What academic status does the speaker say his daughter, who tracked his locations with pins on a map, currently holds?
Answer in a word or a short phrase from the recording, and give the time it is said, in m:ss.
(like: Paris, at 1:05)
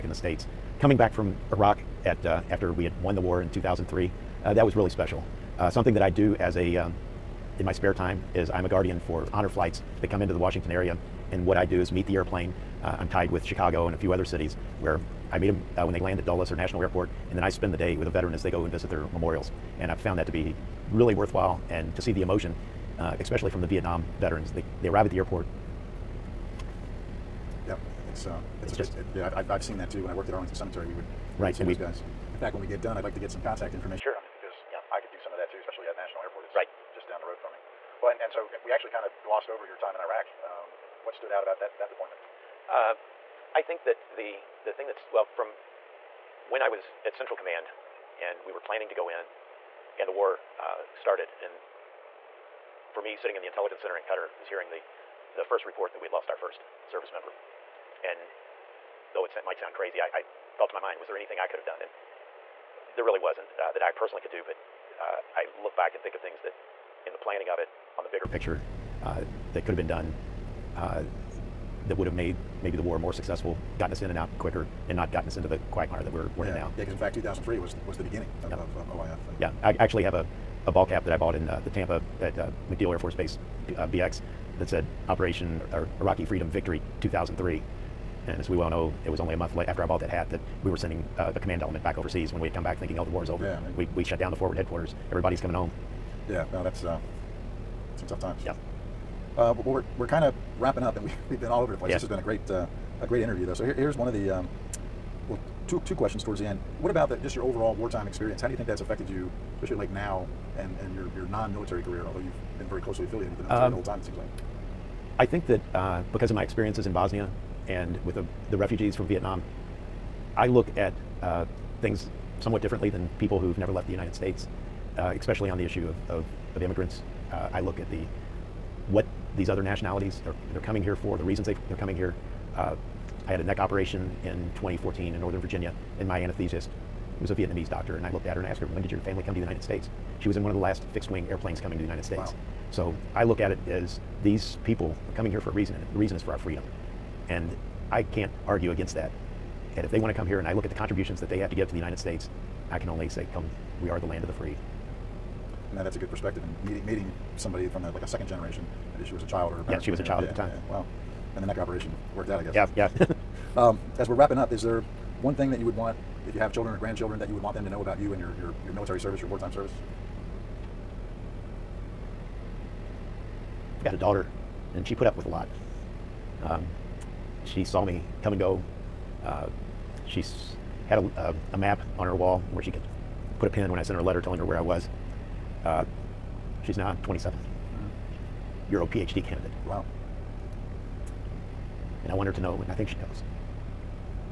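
PhD candidate, at 3:08.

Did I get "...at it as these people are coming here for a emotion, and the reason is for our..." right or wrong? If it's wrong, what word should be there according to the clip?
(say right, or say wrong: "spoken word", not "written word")
wrong: "reason", not "emotion".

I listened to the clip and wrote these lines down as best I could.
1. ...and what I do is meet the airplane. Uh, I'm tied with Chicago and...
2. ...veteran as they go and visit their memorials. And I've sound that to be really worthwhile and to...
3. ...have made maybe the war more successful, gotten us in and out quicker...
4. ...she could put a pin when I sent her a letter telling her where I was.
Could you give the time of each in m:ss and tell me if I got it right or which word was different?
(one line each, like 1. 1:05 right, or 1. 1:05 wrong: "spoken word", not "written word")
1. 0:11 right
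2. 0:18 wrong: "found", not "sound"
3. 1:12 right
4. 3:02 right.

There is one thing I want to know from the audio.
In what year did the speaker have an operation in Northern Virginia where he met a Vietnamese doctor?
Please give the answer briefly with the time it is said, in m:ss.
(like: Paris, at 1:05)
2014, at 2:14.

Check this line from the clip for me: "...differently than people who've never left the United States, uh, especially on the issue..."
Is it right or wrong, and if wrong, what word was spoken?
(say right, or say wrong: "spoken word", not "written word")
right.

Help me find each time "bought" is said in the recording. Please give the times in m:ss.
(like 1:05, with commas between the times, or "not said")
1:21, 1:29.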